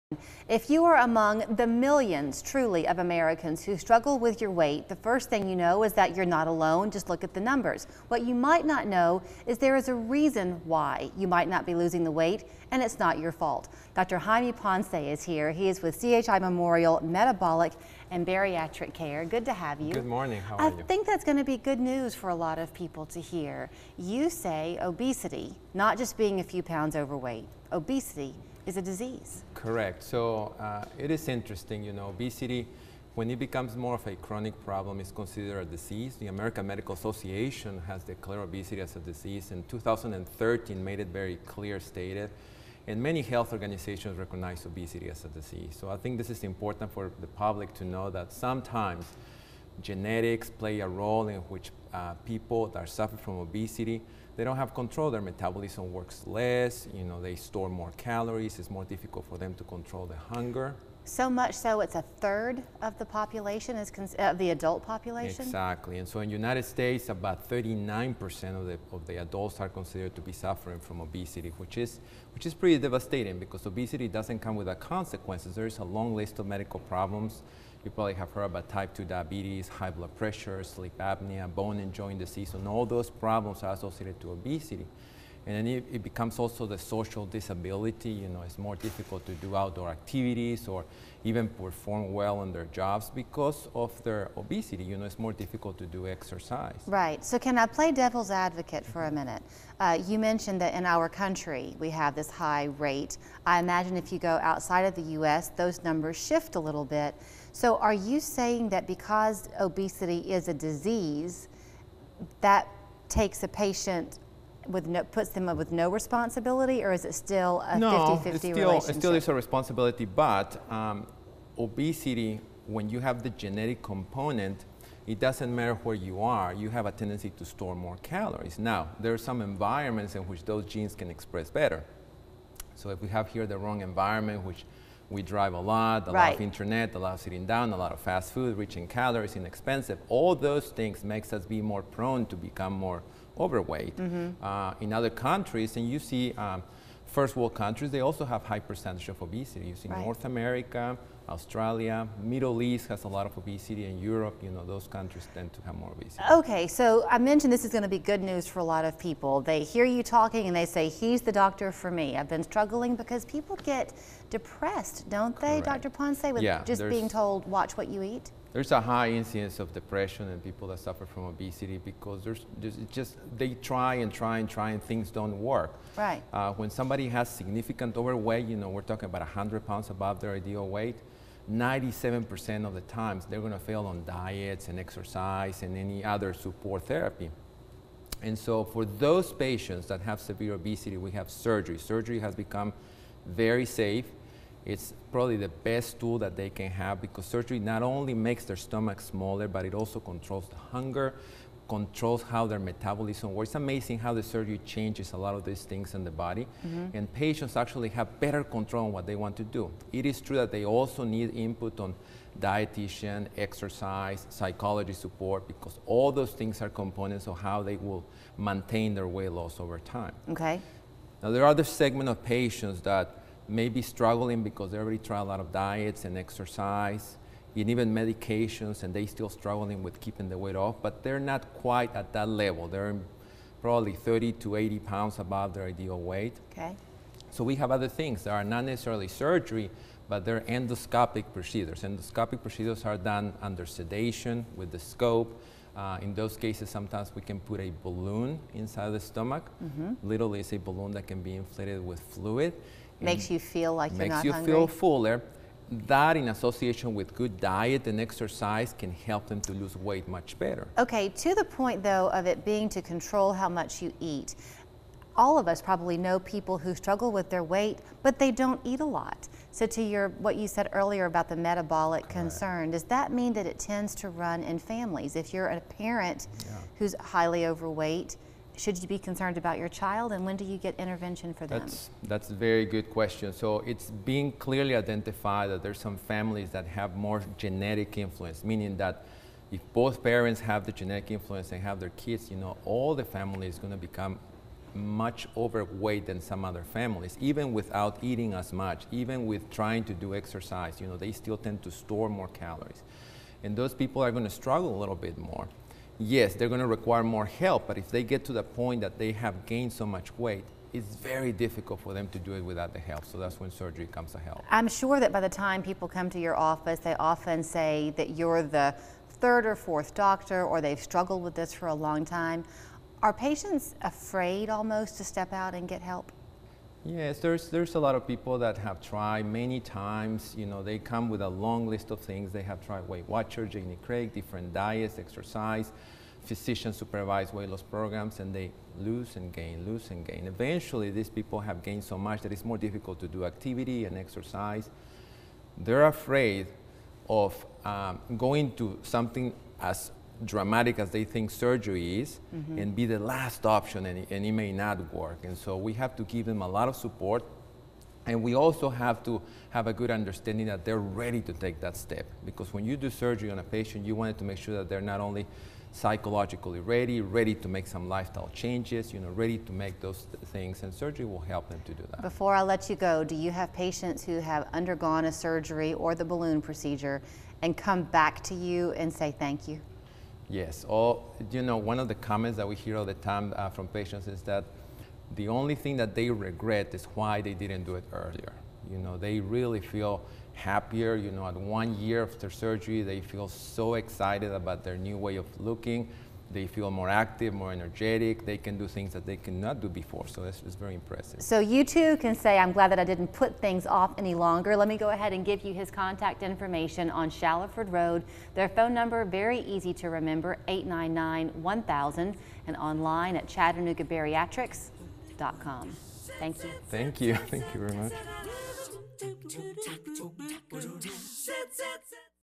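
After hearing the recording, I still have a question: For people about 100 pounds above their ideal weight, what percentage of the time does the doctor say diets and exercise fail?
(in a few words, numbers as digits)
97%.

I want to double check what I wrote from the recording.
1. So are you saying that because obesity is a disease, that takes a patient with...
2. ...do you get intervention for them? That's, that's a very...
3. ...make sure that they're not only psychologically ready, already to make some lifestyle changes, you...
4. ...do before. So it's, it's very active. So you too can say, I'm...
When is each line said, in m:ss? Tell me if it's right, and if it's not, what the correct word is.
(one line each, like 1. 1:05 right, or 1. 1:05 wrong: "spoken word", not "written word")
1. 1:47 right
2. 4:40 right
3. 6:04 wrong: "ready", not "already"
4. 6:39 wrong: "impressive", not "active".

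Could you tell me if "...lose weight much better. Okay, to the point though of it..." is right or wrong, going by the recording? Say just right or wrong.
right.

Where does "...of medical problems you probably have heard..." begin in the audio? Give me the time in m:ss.
1:16.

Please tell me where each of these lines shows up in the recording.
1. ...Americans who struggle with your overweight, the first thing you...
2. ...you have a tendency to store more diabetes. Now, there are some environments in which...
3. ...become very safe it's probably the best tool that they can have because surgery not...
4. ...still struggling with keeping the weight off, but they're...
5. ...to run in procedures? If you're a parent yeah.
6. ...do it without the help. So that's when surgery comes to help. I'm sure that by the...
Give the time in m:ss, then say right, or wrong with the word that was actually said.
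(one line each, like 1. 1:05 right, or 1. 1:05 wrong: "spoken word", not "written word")
1. 0:02 wrong: "weight", not "overweight"
2. 2:06 wrong: "calories", not "diabetes"
3. 3:12 right
4. 3:49 right
5. 4:33 wrong: "families", not "procedures"
6. 5:12 right.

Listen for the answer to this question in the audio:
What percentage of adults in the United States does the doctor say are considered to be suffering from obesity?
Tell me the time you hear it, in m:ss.
1:07.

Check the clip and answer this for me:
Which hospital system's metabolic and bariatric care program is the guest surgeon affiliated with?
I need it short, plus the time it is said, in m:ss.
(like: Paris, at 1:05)
CHI Memorial, at 0:16.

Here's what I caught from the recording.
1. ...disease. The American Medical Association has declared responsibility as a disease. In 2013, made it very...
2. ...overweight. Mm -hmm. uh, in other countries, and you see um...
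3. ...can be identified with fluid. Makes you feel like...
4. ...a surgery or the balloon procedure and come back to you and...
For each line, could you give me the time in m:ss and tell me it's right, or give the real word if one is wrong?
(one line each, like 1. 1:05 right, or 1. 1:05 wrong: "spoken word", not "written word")
1. 0:35 wrong: "obesity", not "responsibility"
2. 2:23 right
3. 4:11 wrong: "inflated", not "identified"
4. 6:15 right.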